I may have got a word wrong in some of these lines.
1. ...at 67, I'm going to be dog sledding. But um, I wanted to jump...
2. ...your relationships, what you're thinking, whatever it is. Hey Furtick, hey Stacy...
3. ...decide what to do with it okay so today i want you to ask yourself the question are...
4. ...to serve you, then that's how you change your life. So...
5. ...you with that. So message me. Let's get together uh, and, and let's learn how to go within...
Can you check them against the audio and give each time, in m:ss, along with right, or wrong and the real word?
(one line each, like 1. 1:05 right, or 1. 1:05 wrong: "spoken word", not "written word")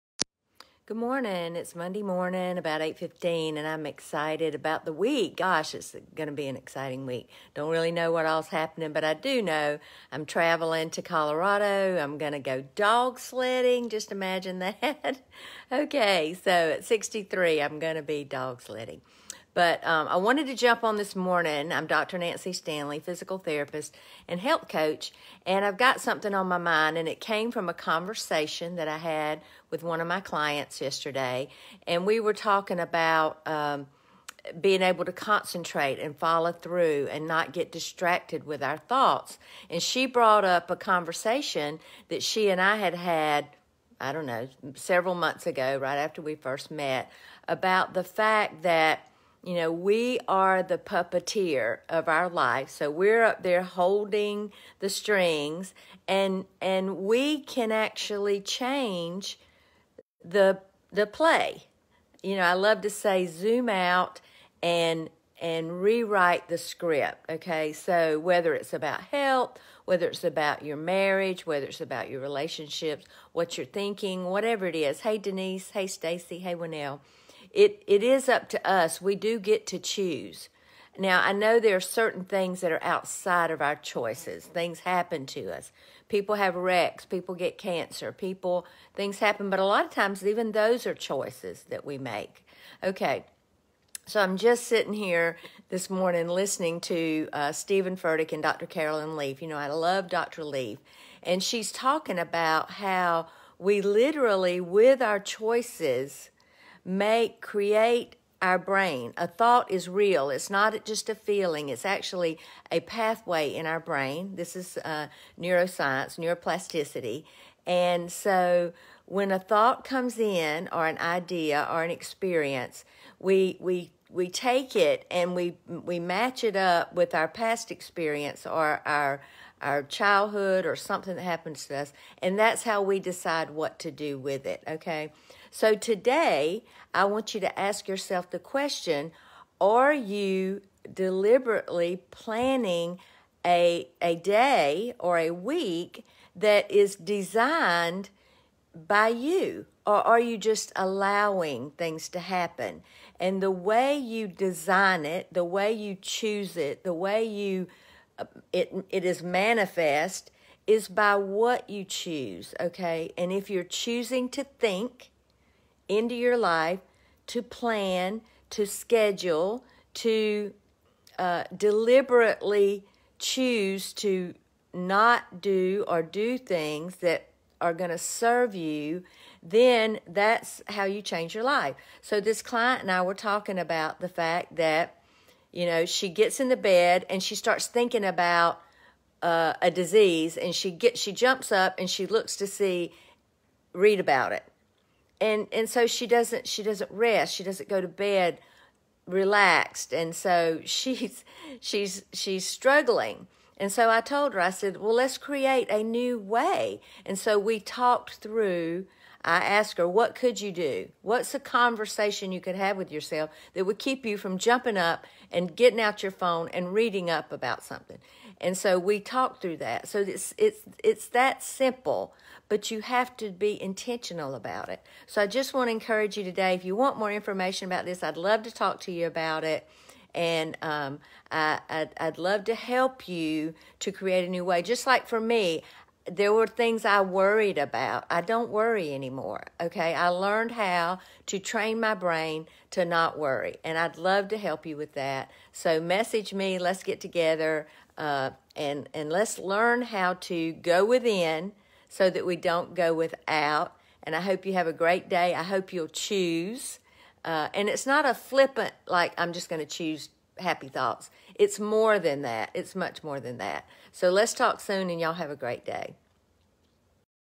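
1. 0:16 wrong: "63", not "67"
2. 1:12 wrong: "Denise", not "Furtick"
3. 2:12 right
4. 2:57 right
5. 4:04 right.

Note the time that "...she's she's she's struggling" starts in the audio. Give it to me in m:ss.
3:20.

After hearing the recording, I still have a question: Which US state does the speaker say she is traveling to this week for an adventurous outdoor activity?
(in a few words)
Colorado.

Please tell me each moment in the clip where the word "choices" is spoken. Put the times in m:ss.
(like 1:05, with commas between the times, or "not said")
1:23, 1:30, 1:45.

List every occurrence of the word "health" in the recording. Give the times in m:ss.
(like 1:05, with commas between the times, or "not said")
0:24, 1:09.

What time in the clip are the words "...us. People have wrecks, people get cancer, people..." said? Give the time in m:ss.
1:25.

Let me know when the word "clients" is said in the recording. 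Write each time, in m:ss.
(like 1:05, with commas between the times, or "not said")
0:30, 3:02.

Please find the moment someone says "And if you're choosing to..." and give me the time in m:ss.
2:43.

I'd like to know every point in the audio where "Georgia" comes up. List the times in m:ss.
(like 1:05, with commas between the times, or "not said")
not said.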